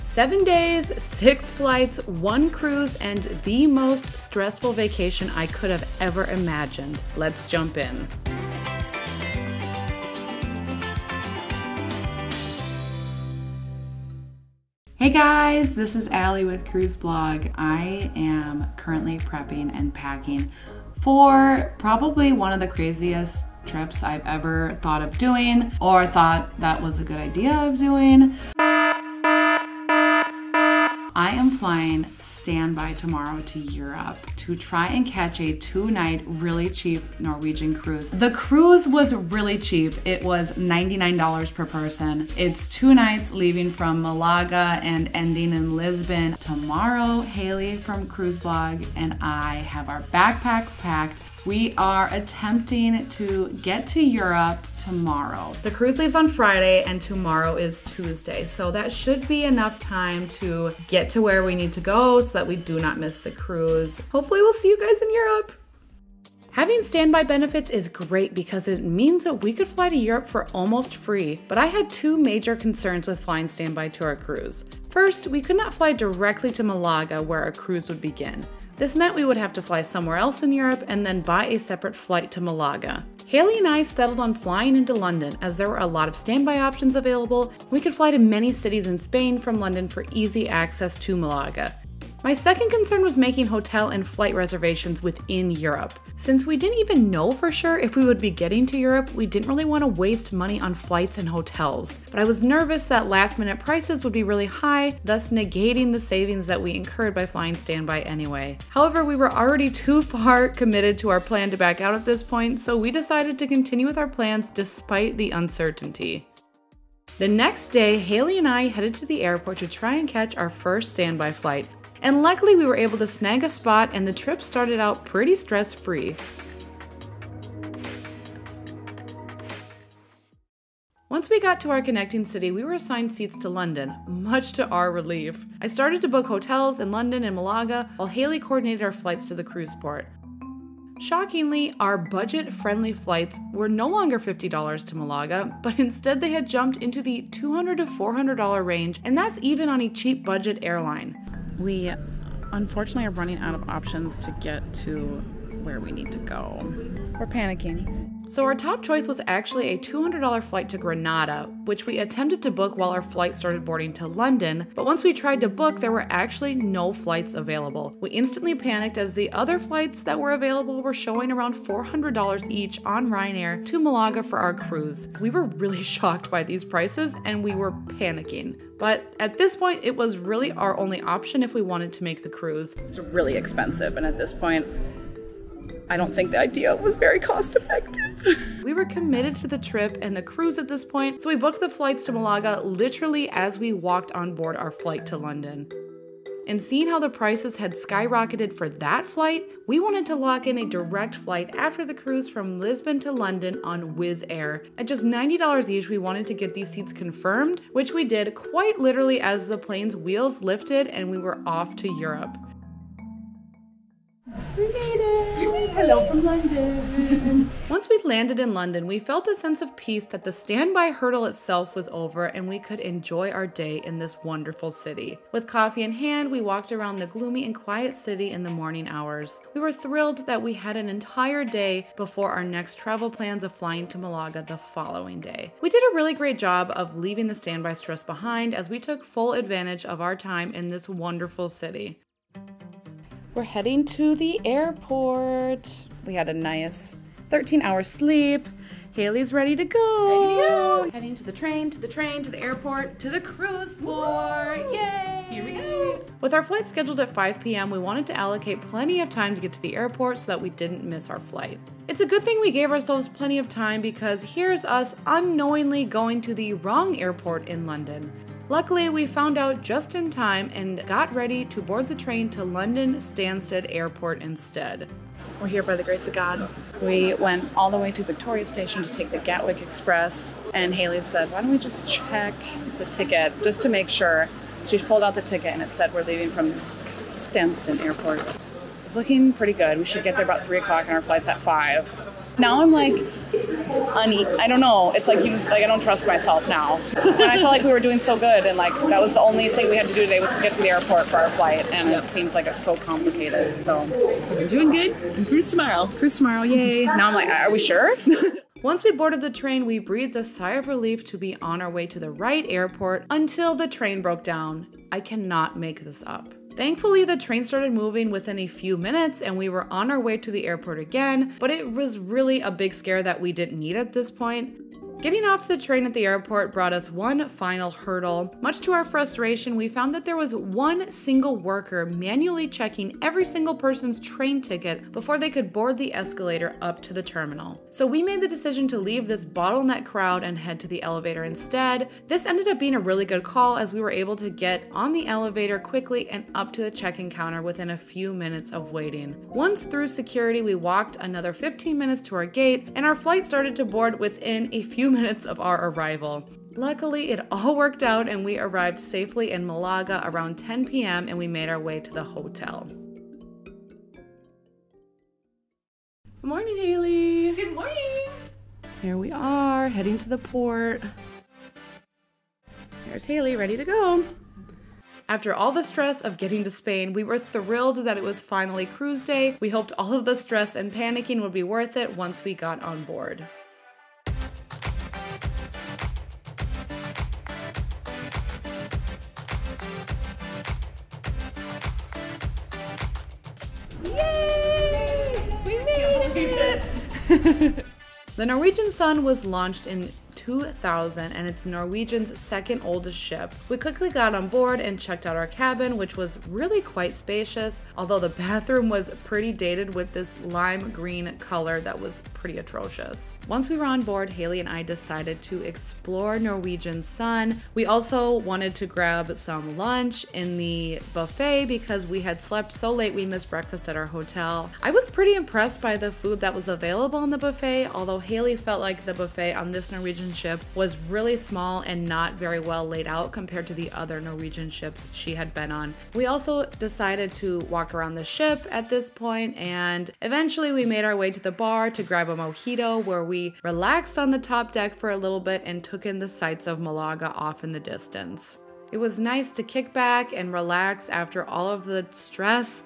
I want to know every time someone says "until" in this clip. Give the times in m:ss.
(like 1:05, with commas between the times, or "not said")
5:13.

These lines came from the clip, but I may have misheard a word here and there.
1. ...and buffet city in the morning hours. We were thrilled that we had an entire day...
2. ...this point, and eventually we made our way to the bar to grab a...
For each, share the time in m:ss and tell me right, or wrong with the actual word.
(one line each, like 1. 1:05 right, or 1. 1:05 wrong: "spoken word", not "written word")
1. 3:47 wrong: "quiet", not "buffet"
2. 7:18 right.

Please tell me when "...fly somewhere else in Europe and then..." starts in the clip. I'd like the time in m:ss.
1:19.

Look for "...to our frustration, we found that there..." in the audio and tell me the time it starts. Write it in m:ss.
5:28.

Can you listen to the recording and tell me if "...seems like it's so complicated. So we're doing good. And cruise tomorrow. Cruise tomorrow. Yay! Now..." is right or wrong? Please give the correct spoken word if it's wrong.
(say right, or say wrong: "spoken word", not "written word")
right.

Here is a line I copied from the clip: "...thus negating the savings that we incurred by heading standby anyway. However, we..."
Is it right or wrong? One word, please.
wrong.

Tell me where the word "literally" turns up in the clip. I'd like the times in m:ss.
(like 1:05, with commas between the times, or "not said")
3:12, 3:28.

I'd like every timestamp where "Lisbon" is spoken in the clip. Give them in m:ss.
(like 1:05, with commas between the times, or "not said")
0:45, 3:22.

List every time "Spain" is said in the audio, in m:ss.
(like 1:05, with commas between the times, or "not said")
1:28, 6:16.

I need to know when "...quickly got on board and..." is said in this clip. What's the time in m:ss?
6:43.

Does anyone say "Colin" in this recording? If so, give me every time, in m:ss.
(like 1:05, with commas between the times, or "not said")
not said.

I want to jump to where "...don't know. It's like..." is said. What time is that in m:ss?
4:54.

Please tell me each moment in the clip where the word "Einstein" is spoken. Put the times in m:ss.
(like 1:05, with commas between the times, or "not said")
not said.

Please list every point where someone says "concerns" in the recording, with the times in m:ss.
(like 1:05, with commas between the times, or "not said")
1:12, 1:32.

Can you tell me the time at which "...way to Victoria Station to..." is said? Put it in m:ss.
4:37.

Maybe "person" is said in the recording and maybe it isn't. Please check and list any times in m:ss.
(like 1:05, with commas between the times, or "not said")
0:41, 5:33.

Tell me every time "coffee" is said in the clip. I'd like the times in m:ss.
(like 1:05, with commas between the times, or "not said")
3:45.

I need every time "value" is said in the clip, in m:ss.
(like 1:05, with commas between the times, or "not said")
not said.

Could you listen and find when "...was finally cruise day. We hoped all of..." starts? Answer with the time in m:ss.
6:18.